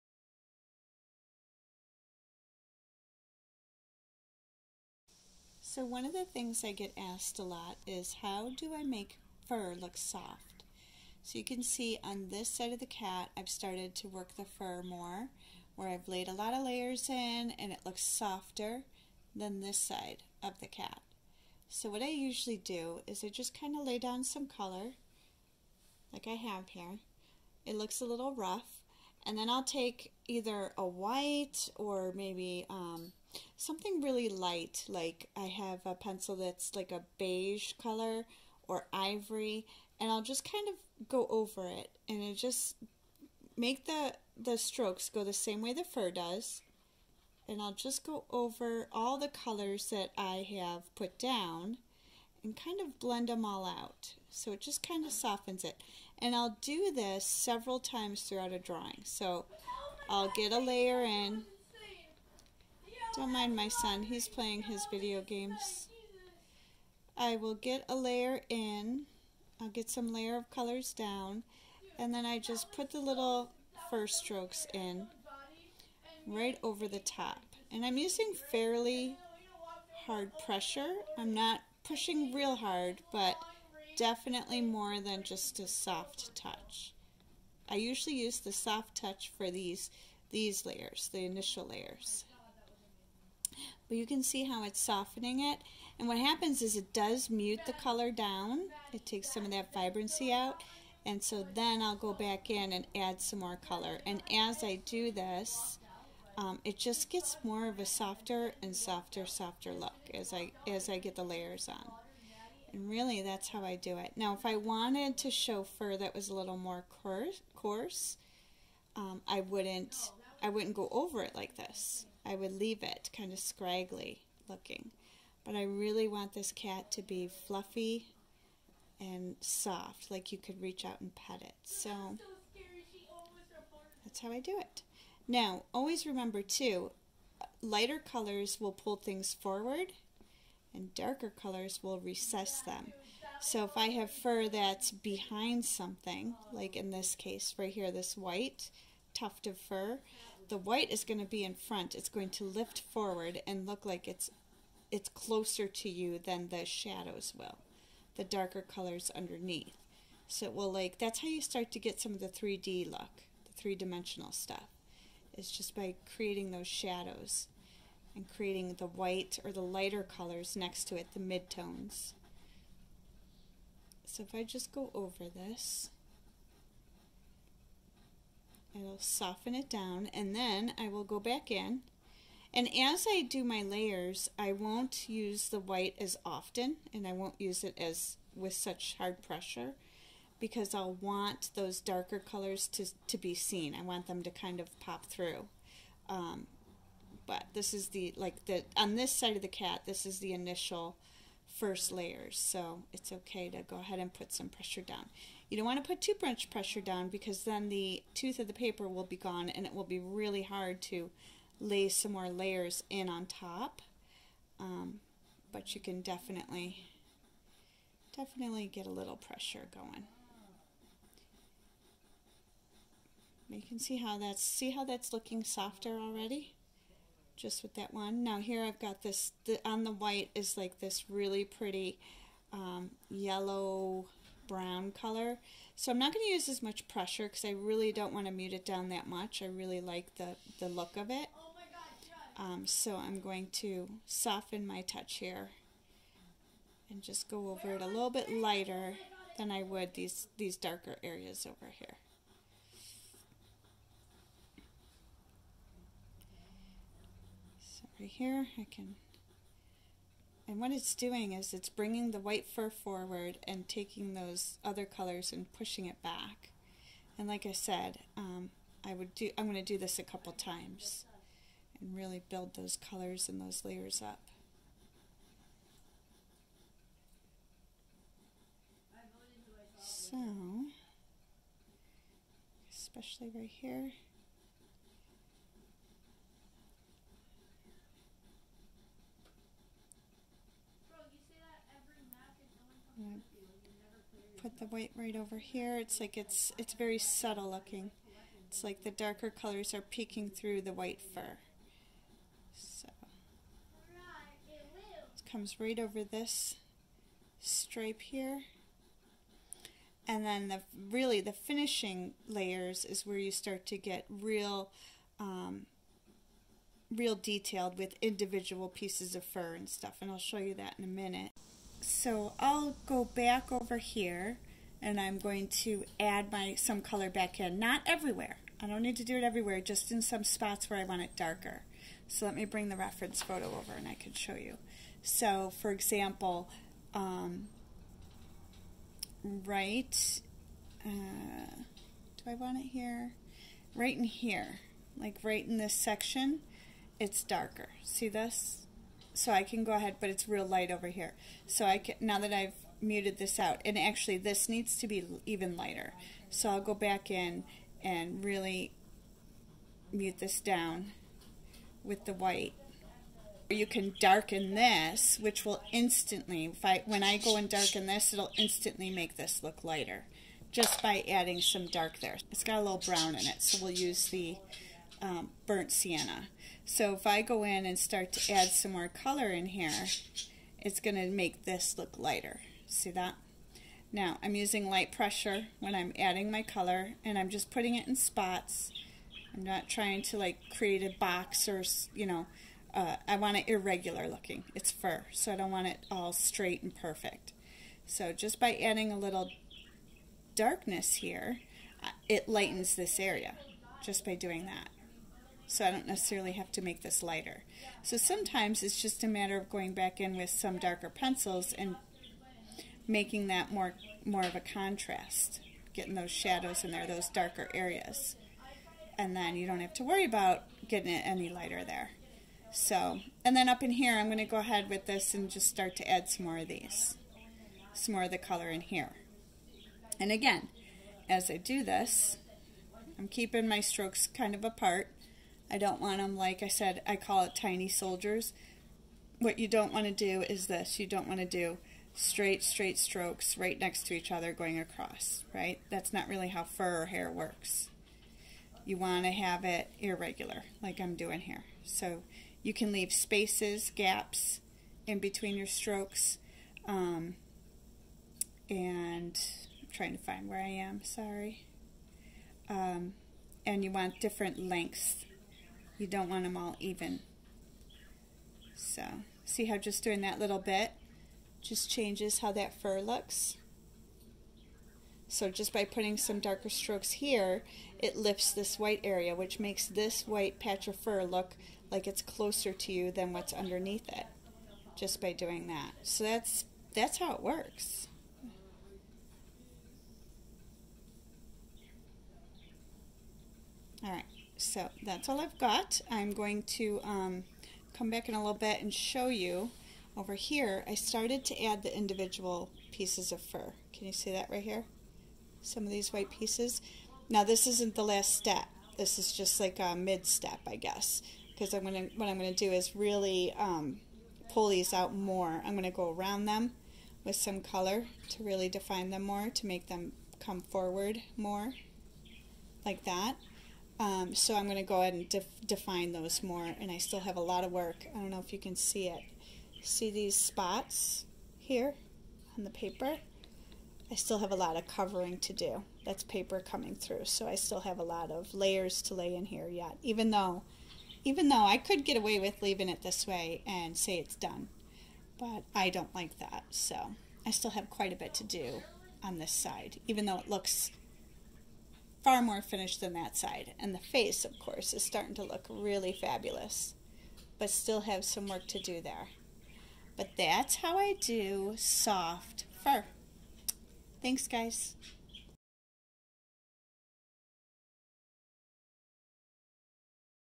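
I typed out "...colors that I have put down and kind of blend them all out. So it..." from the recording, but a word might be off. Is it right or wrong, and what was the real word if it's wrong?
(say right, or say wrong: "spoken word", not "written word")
right.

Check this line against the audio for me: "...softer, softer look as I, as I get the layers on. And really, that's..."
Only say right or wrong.
right.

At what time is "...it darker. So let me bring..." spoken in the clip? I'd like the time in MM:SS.
05:31.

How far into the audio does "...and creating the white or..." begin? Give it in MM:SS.
02:48.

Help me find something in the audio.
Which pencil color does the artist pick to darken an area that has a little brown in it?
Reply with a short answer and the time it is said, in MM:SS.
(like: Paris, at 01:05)
burnt sienna, at 06:15.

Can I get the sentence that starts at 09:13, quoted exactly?
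And the face, of course, is starting to look really fabulous, but still have some work to do there.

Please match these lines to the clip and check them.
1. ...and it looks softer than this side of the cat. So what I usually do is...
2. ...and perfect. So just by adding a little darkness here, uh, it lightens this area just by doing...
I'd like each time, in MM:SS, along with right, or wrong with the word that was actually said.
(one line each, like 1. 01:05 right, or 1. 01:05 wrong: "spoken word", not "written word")
1. 00:17 right
2. 06:36 right.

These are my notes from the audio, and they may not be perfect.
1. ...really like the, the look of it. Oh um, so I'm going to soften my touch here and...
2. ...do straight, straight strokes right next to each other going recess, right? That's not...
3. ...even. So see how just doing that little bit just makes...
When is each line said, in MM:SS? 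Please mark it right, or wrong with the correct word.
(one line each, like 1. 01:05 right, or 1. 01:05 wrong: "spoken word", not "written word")
1. 03:59 right
2. 07:21 wrong: "across", not "recess"
3. 07:46 wrong: "changes", not "makes".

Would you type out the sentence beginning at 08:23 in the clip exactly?
Can you see that right here?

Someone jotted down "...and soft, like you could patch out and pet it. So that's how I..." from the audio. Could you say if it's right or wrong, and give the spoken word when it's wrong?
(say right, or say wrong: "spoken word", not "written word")
wrong: "reach", not "patch".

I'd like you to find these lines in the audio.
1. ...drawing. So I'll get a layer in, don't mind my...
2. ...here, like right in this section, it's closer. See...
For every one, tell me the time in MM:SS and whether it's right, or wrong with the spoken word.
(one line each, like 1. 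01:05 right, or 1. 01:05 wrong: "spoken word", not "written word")
1. 00:58 right
2. 05:44 wrong: "darker", not "closer".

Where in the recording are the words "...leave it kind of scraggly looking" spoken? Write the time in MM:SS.
02:02.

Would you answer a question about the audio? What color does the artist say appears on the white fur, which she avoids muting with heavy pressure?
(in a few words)
yellow brown.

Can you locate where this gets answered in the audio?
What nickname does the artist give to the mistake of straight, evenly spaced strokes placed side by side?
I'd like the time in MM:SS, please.
07:17.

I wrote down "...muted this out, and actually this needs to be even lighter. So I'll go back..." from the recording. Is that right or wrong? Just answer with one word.
right.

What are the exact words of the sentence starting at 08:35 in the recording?
I'm gonna go around them with some color to really define them more, to make them come forward more, like that.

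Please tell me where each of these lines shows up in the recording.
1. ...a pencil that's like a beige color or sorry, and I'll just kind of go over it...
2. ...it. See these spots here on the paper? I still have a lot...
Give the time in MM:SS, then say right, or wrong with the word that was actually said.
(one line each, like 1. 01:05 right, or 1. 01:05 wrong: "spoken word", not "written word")
1. 00:35 wrong: "ivory", not "sorry"
2. 08:48 right.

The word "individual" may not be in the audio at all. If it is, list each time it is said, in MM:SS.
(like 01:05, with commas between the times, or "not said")
05:18, 08:21.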